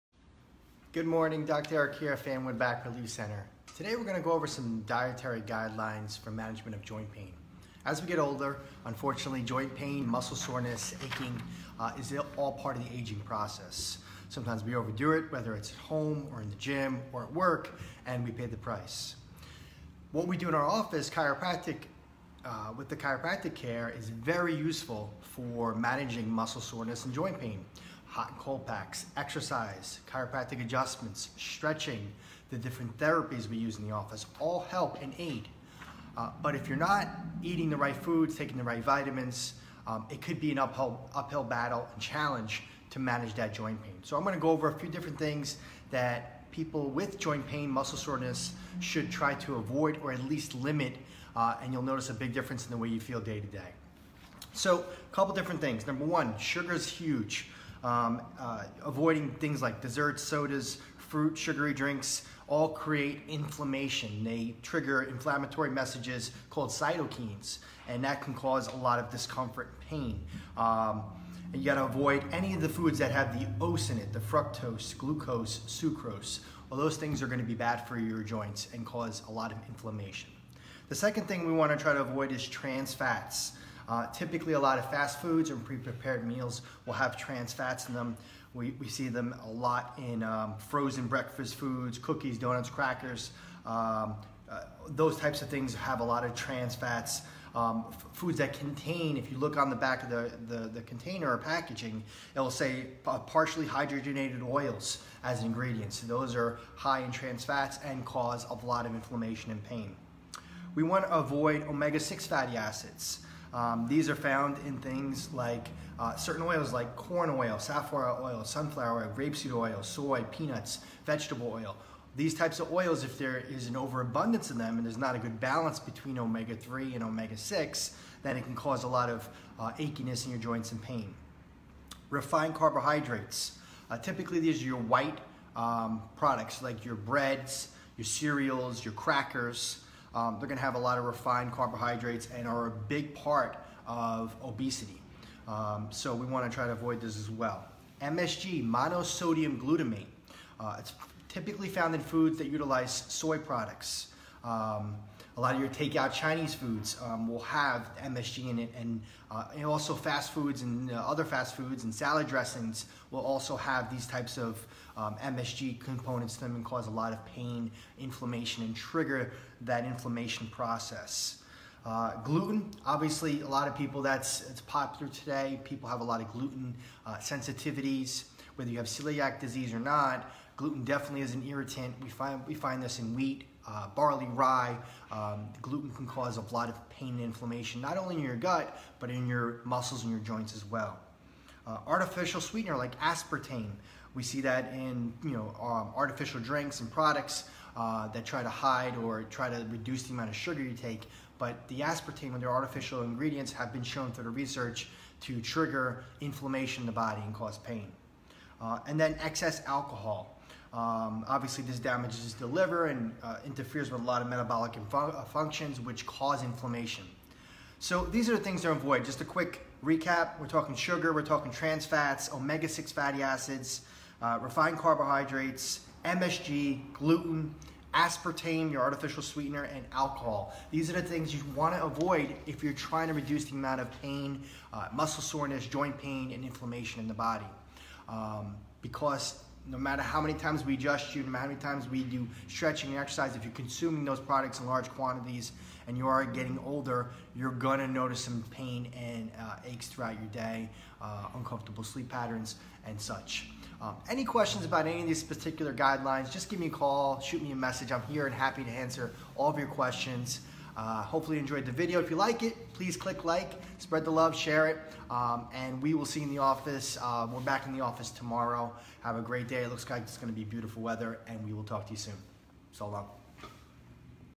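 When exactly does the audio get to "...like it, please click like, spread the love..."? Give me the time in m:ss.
4:22.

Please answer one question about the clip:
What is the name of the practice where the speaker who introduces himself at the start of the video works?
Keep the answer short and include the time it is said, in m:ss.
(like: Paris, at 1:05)
Fanwood Back Relief Center, at 0:02.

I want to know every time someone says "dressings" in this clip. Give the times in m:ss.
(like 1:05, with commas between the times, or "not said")
2:42.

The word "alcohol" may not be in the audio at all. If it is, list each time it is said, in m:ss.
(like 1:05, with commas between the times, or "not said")
3:29, 3:49.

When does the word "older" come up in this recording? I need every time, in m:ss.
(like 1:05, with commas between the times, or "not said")
0:08, 4:06.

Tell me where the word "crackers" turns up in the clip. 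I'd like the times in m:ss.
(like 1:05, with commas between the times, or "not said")
1:32, 2:18.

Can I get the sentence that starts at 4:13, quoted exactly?
Um, any questions about any of these particular guidelines, just give me a call, shoot me a message.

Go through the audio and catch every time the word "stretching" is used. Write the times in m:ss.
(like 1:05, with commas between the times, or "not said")
0:31, 4:02.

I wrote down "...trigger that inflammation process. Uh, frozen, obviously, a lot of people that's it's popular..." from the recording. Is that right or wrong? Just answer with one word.
wrong.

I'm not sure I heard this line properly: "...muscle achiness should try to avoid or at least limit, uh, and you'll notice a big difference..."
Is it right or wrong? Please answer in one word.
wrong.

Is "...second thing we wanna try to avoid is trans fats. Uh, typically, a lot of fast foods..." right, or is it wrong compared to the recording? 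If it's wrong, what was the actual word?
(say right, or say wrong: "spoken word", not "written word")
right.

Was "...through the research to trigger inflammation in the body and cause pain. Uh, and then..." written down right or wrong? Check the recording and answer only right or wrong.
right.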